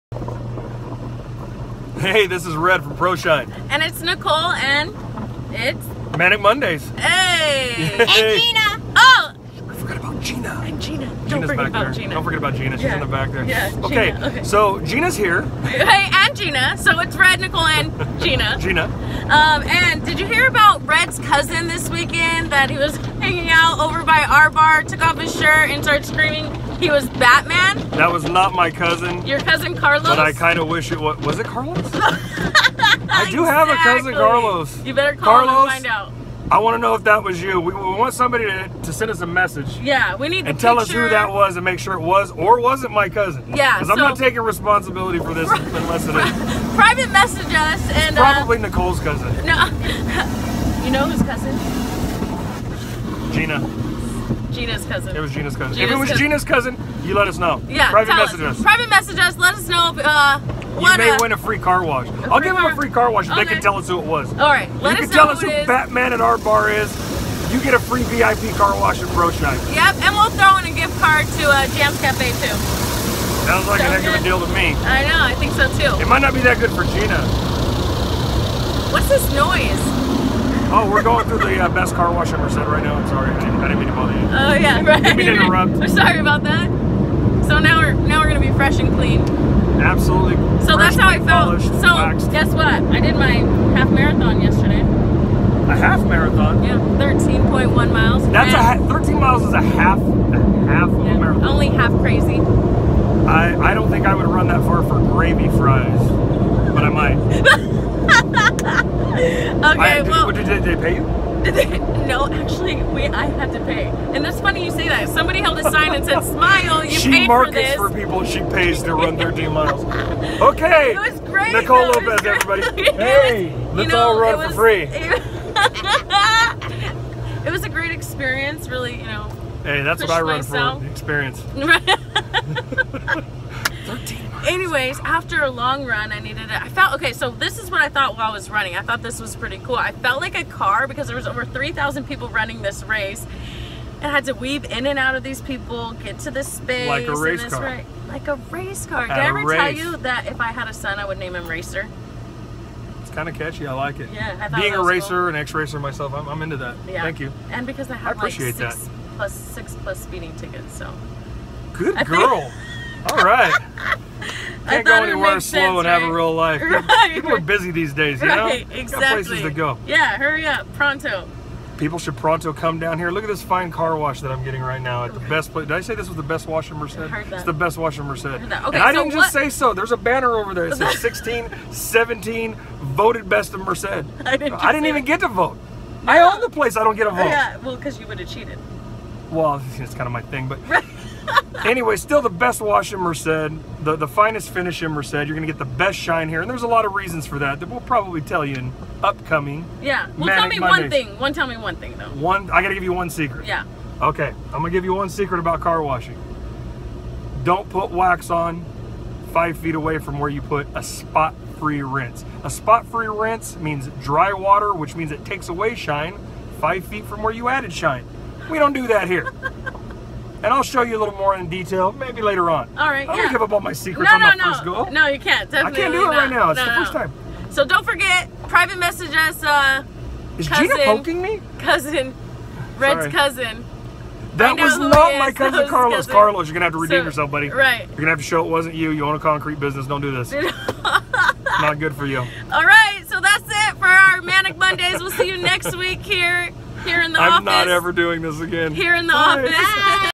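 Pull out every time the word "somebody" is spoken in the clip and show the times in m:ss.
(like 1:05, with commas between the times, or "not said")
0:38, 1:55.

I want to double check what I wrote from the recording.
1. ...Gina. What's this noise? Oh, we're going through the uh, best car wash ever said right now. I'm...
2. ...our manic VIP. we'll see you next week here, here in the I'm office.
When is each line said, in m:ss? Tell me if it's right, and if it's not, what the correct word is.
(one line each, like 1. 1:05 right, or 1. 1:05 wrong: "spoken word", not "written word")
1. 1:16 right
2. 4:03 wrong: "Mondays", not "VIP".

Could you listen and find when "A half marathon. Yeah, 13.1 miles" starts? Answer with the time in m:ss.
1:34.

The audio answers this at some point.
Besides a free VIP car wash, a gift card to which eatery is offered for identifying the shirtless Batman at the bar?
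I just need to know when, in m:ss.
1:11.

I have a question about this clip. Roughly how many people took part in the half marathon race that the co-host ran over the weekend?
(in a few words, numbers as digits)
3,000.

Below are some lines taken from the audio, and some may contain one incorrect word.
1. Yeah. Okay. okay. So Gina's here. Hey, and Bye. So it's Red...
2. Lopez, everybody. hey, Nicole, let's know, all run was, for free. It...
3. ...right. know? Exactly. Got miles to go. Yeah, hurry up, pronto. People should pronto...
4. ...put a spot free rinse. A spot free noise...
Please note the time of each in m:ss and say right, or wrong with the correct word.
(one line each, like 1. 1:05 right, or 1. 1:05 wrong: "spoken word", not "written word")
1. 0:13 wrong: "Gina", not "Bye"
2. 2:01 right
3. 2:48 wrong: "places", not "miles"
4. 3:30 wrong: "rinse", not "noise".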